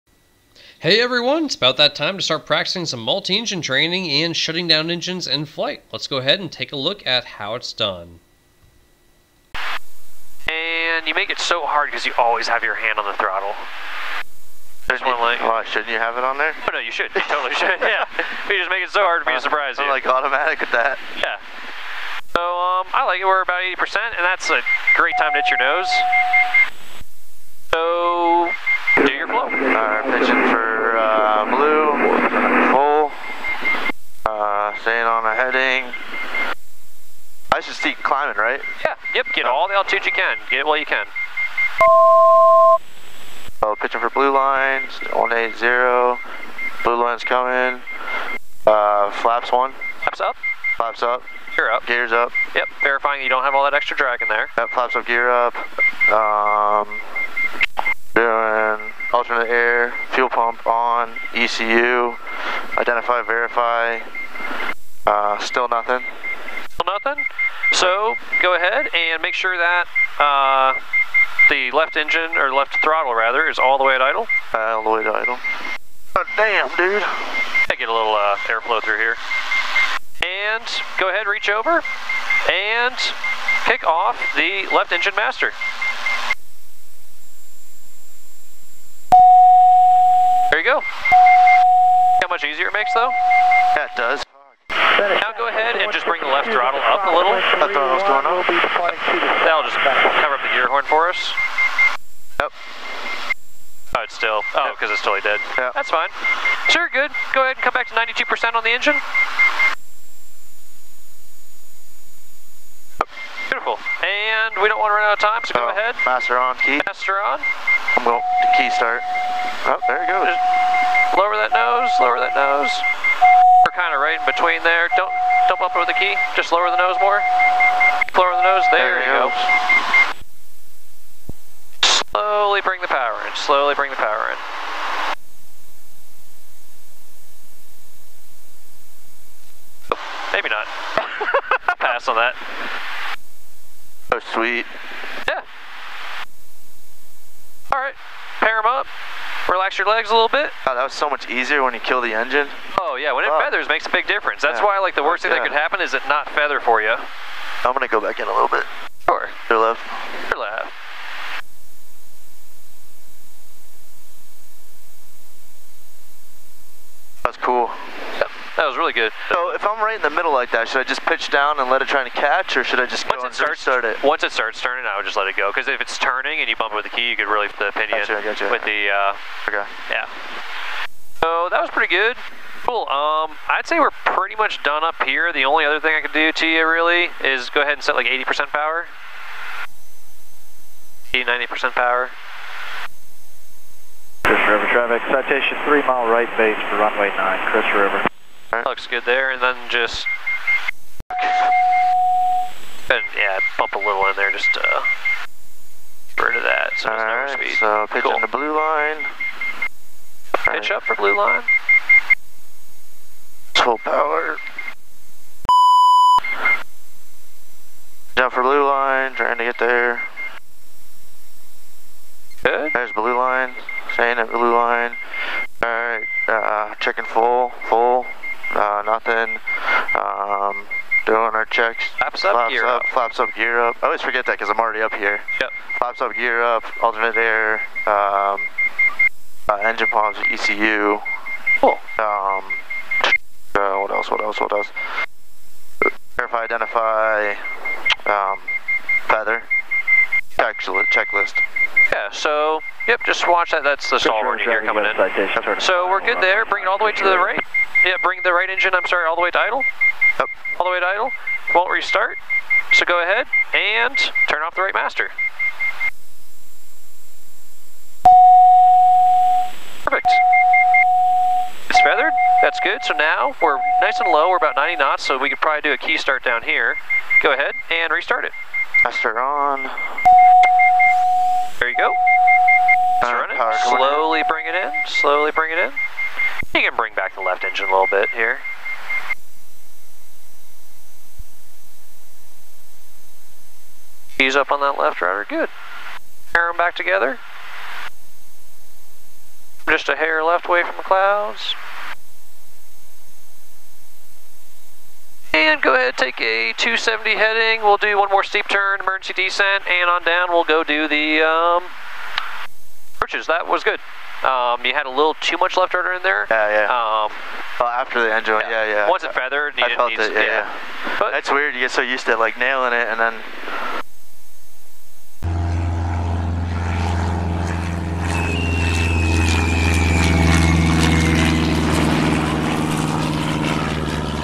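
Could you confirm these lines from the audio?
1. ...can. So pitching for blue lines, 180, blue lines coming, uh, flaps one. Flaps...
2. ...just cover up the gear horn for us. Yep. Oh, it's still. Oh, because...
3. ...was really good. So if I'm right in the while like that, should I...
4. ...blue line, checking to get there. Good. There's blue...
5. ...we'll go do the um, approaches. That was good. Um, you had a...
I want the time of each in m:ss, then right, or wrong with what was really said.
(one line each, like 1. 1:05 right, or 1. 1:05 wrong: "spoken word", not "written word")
1. 0:40 right
2. 1:39 right
3. 2:48 wrong: "middle", not "while"
4. 3:38 wrong: "trying", not "checking"
5. 5:10 right.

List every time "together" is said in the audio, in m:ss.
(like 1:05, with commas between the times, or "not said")
4:56.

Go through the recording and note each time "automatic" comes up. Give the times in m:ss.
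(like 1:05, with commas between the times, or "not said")
0:20.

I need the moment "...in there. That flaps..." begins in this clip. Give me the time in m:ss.
0:54.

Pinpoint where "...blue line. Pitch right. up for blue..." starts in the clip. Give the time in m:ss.
3:28.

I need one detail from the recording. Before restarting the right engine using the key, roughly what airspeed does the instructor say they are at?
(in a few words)
90 knots.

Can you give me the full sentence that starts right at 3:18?
Looks good there, and then just...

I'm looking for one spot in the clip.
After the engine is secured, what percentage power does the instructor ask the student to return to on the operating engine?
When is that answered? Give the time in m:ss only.
1:47.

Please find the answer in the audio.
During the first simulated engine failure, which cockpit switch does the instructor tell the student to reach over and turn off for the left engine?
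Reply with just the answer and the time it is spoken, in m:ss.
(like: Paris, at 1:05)
Left engine master, at 1:24.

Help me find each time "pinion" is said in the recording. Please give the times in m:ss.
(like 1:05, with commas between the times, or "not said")
2:57.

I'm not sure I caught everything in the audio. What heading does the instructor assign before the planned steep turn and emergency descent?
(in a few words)
270.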